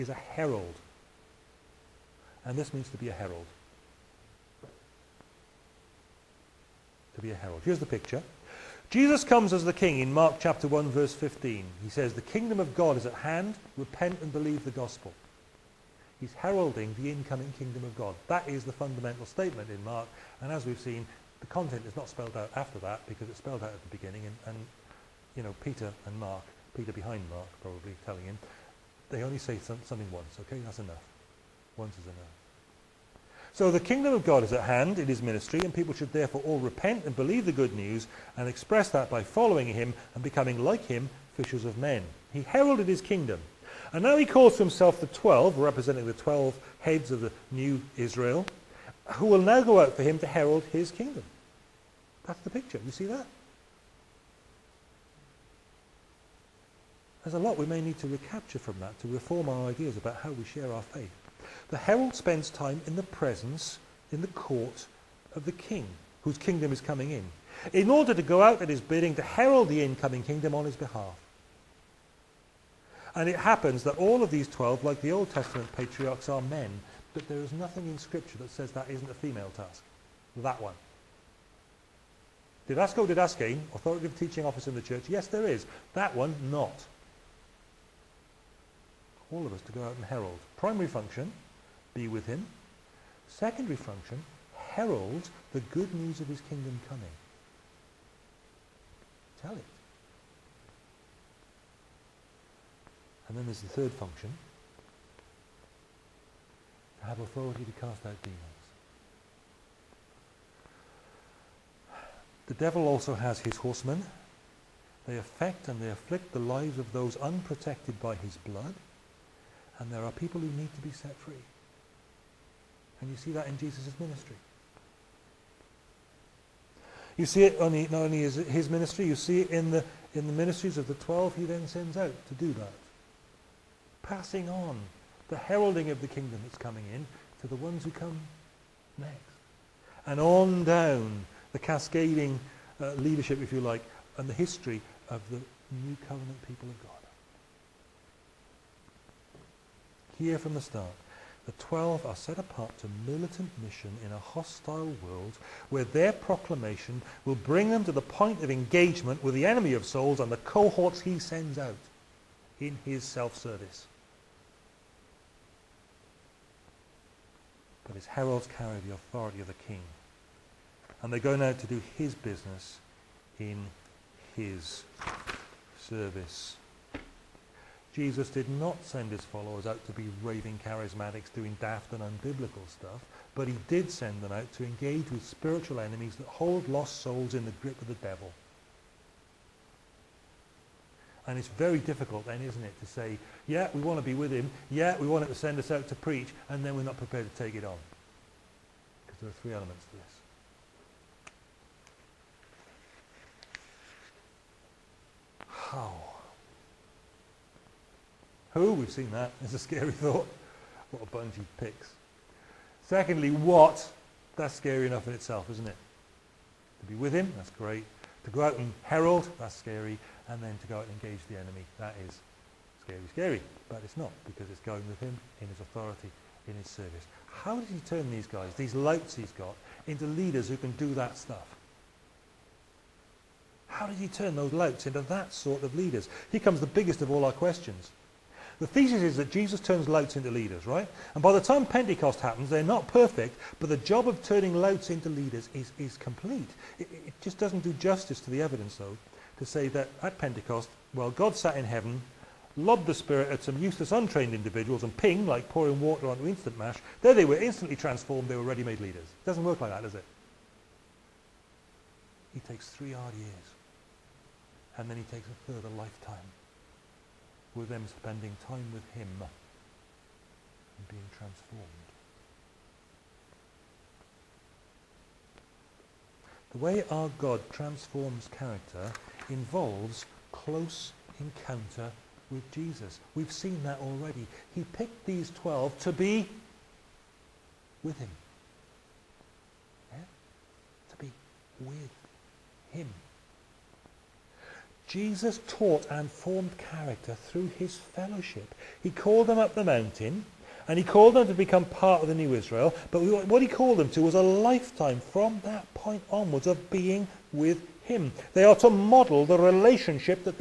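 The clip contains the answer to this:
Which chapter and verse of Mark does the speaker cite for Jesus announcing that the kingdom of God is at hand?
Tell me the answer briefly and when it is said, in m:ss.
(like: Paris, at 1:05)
Chapter 1 verse 15, at 0:10.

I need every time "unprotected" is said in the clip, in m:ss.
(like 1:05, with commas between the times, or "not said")
1:57.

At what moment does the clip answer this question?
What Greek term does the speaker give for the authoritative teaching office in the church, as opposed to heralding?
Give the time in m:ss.
1:22.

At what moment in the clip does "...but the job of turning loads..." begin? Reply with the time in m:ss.
4:03.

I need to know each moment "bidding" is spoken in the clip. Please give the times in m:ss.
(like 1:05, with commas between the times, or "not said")
1:08.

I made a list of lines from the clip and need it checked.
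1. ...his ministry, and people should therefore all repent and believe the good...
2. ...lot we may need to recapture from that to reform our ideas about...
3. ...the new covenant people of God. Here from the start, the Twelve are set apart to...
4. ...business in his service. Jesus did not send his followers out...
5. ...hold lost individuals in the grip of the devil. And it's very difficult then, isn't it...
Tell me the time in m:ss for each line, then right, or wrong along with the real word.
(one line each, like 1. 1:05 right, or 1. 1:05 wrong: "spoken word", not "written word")
1. 0:35 right
2. 0:57 right
3. 2:25 right
4. 2:52 right
5. 3:06 wrong: "souls", not "individuals".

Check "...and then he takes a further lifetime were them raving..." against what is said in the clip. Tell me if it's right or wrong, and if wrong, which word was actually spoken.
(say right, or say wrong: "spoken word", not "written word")
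wrong: "spending", not "raving".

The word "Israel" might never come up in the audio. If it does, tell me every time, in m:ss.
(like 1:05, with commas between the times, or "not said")
0:47, 5:02.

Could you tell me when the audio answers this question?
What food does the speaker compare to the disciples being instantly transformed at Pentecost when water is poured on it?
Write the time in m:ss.
4:16.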